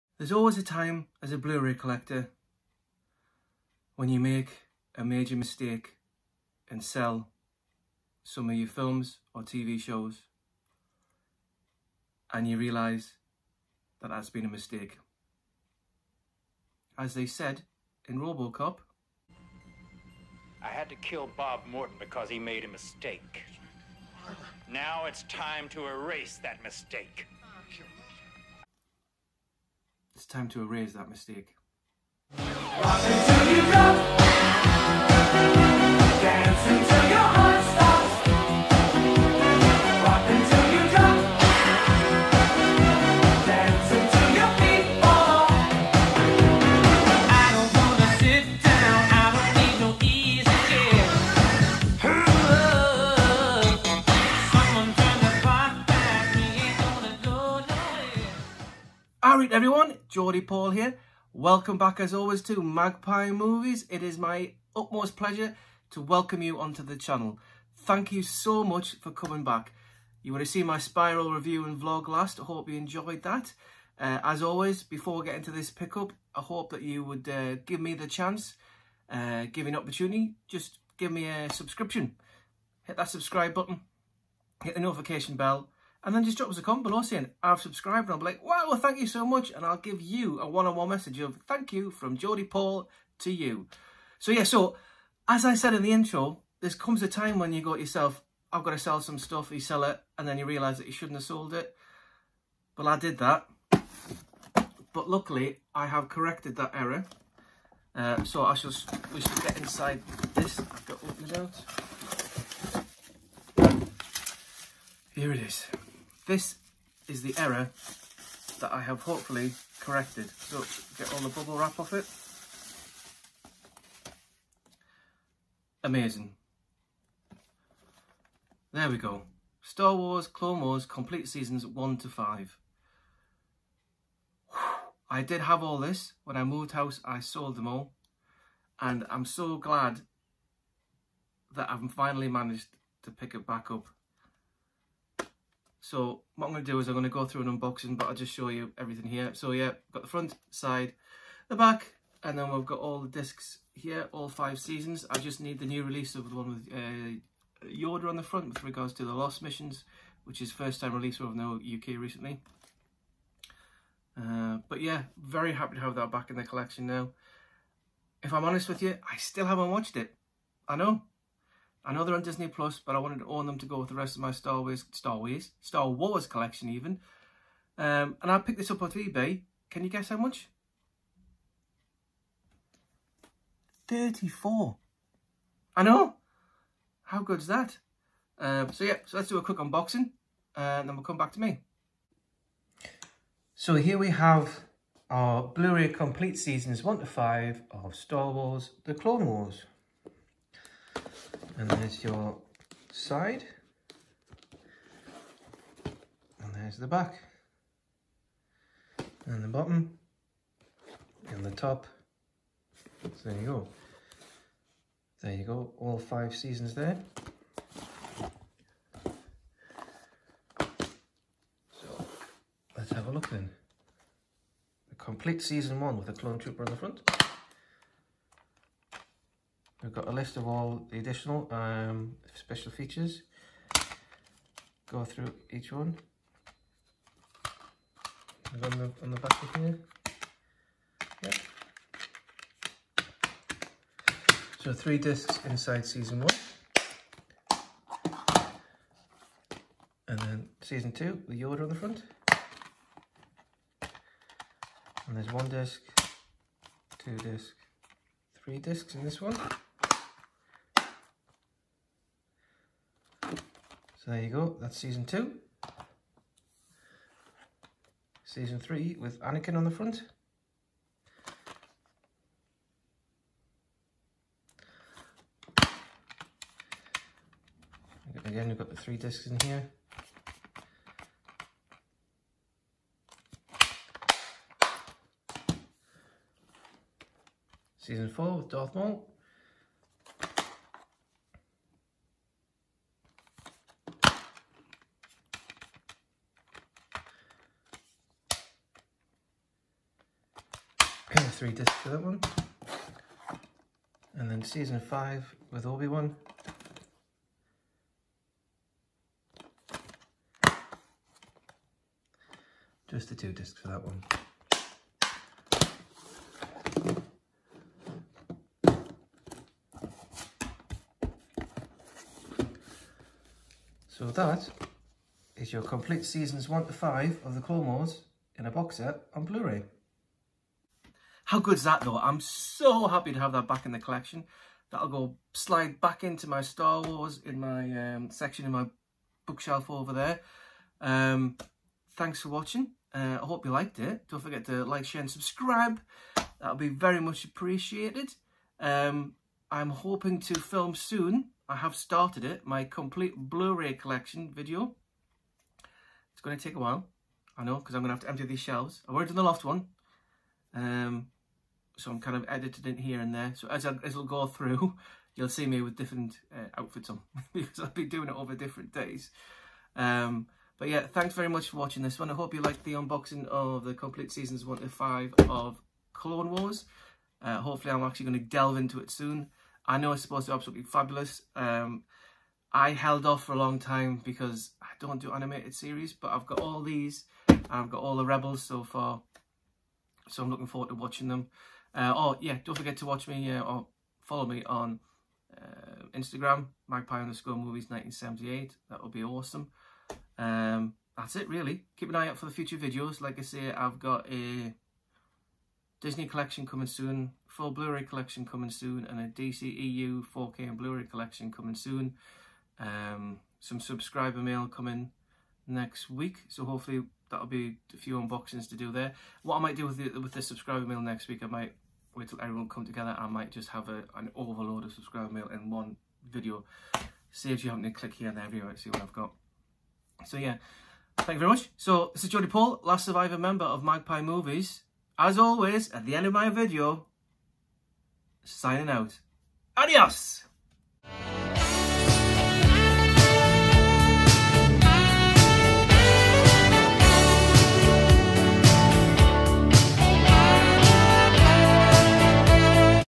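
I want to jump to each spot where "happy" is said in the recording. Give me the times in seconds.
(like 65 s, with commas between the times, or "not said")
165 s, 332 s.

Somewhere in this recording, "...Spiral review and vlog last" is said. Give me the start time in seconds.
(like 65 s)
70 s.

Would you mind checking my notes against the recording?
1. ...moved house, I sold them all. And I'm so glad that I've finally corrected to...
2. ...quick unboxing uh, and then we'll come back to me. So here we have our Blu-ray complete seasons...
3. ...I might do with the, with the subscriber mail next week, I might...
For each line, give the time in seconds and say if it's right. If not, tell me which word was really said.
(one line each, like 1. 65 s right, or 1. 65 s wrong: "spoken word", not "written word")
1. 136 s wrong: "managed", not "corrected"
2. 189 s right
3. 419 s right.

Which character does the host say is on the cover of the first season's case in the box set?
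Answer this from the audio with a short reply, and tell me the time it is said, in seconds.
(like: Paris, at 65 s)
clone trooper, at 226 s.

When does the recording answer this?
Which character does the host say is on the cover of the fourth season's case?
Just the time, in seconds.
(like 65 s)
288 s.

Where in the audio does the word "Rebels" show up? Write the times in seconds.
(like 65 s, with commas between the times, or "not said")
388 s.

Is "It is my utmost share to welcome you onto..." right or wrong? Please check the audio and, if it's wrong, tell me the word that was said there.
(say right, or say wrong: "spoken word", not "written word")
wrong: "pleasure", not "share".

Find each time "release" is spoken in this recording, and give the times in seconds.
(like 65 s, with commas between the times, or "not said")
155 s, 160 s.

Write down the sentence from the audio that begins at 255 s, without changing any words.
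And there's one disc, two disc, three discs in this one.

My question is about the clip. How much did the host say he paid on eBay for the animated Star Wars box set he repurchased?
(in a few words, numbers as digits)
34.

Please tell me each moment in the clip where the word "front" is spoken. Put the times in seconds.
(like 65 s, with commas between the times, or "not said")
150 s, 158 s, 226 s, 251 s, 269 s.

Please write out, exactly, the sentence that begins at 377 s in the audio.
Uh, hopefully I'm actually going to delve into it soon.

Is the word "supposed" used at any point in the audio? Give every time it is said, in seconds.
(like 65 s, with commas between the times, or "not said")
380 s.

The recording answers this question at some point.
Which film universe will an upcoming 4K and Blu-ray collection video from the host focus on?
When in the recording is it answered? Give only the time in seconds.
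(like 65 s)
409 s.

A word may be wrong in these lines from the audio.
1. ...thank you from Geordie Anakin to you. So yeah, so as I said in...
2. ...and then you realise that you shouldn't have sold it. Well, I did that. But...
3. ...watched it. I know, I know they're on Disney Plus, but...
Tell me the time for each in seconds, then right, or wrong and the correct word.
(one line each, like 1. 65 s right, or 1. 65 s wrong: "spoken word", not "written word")
1. 91 s wrong: "Paul", not "Anakin"
2. 100 s right
3. 169 s right.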